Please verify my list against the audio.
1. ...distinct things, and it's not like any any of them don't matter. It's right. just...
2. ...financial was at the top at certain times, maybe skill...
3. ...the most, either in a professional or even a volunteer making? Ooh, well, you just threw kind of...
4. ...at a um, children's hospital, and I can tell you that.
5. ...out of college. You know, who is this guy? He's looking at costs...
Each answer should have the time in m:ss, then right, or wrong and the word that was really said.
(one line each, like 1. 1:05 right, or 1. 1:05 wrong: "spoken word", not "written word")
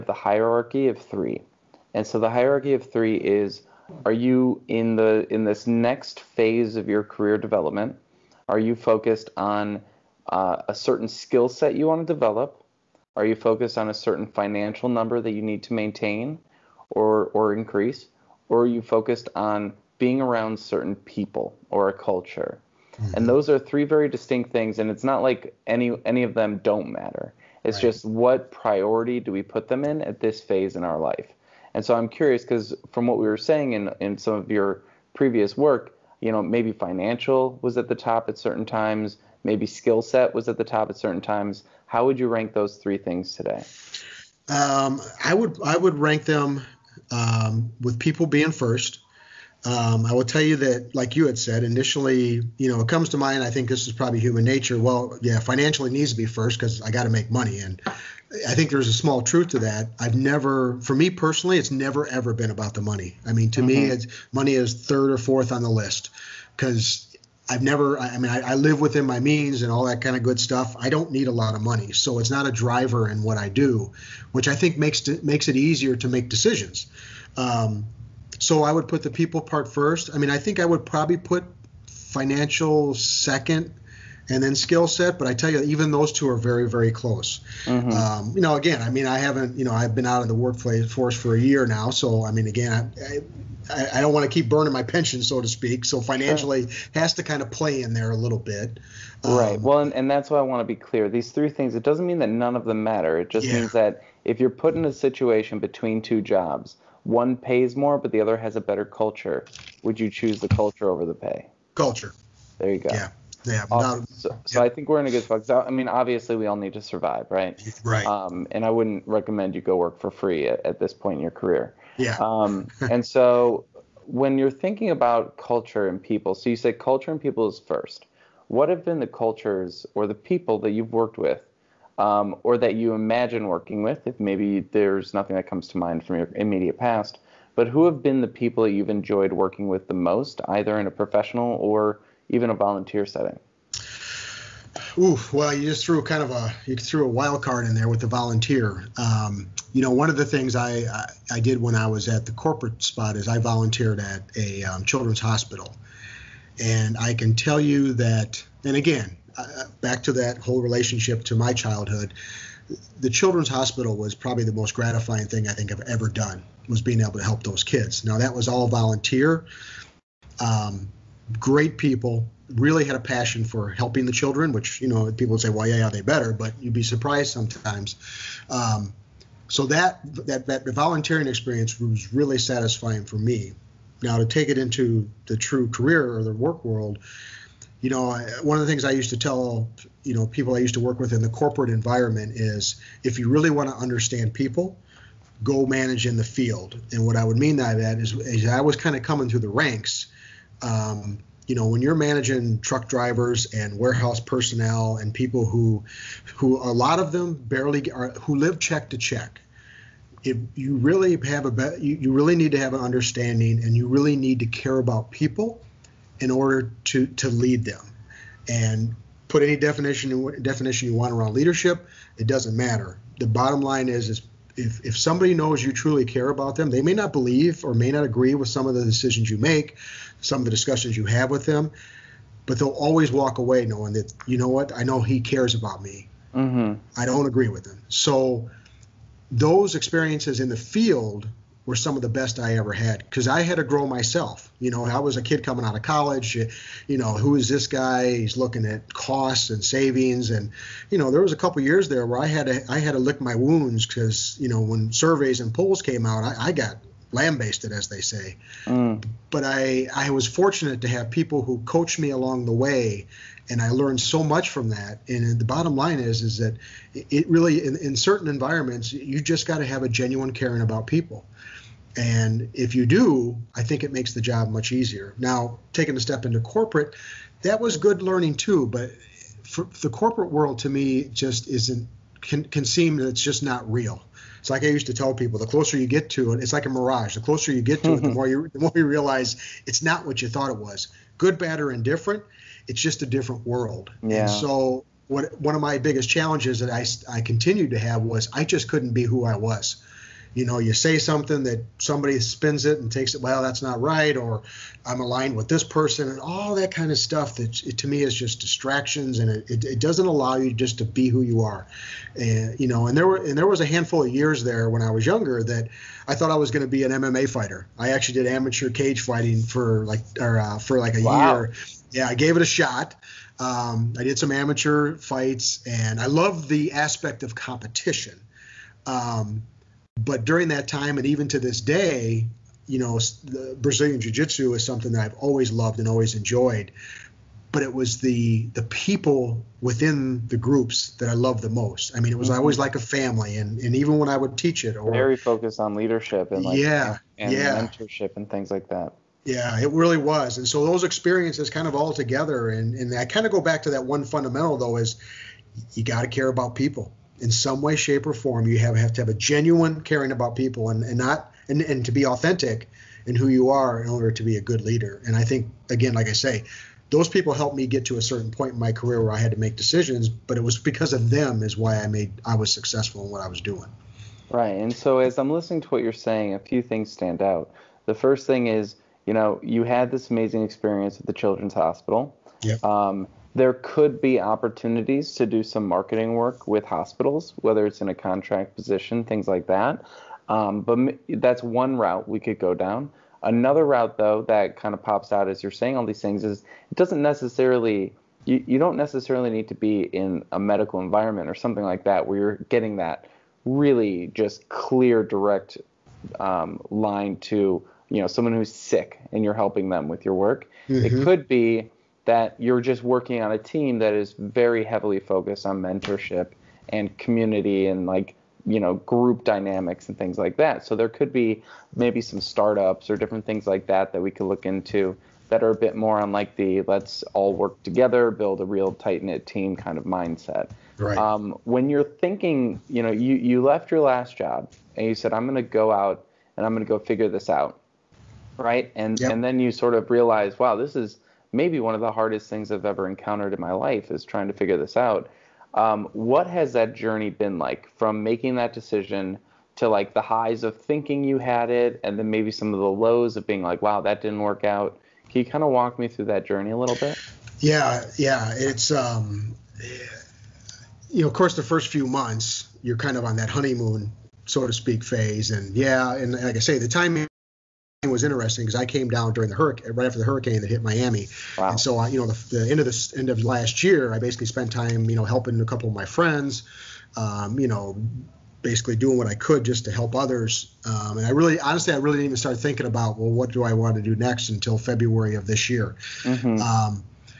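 1. 0:24 right
2. 0:36 right
3. 2:19 wrong: "setting", not "making"
4. 2:33 right
5. 4:05 right.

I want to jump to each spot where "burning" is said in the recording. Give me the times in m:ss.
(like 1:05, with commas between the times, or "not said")
1:34.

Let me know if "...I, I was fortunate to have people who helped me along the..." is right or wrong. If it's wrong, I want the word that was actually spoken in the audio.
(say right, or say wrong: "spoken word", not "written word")
wrong: "coached", not "helped".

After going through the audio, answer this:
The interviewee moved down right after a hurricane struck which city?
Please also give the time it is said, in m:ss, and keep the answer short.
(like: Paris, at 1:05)
Miami, at 7:50.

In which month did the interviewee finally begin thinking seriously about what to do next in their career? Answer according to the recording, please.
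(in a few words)
February.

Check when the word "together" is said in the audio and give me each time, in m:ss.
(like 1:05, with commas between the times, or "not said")
5:51, 7:07.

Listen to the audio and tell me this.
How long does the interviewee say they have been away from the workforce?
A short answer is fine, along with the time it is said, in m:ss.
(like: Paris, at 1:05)
a year, at 1:31.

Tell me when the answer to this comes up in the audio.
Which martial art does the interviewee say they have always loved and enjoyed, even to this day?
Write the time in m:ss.
5:33.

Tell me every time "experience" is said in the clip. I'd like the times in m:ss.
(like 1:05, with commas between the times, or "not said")
3:01, 3:59, 5:50, 6:20.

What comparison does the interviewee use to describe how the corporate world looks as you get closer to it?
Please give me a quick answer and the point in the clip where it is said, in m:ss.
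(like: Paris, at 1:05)
a mirage, at 4:46.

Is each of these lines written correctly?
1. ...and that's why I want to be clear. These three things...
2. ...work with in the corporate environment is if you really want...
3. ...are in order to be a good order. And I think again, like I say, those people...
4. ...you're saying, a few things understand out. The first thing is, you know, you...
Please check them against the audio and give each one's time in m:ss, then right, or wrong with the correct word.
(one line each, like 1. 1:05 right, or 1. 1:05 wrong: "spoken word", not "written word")
1. 1:39 right
2. 3:10 right
3. 6:03 wrong: "leader", not "order"
4. 6:15 wrong: "stand", not "understand".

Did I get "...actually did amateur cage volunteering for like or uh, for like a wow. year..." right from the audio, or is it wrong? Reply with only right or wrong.
wrong.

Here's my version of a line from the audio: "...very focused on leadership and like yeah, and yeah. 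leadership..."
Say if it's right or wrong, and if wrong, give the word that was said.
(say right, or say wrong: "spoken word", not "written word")
wrong: "mentorship", not "leadership".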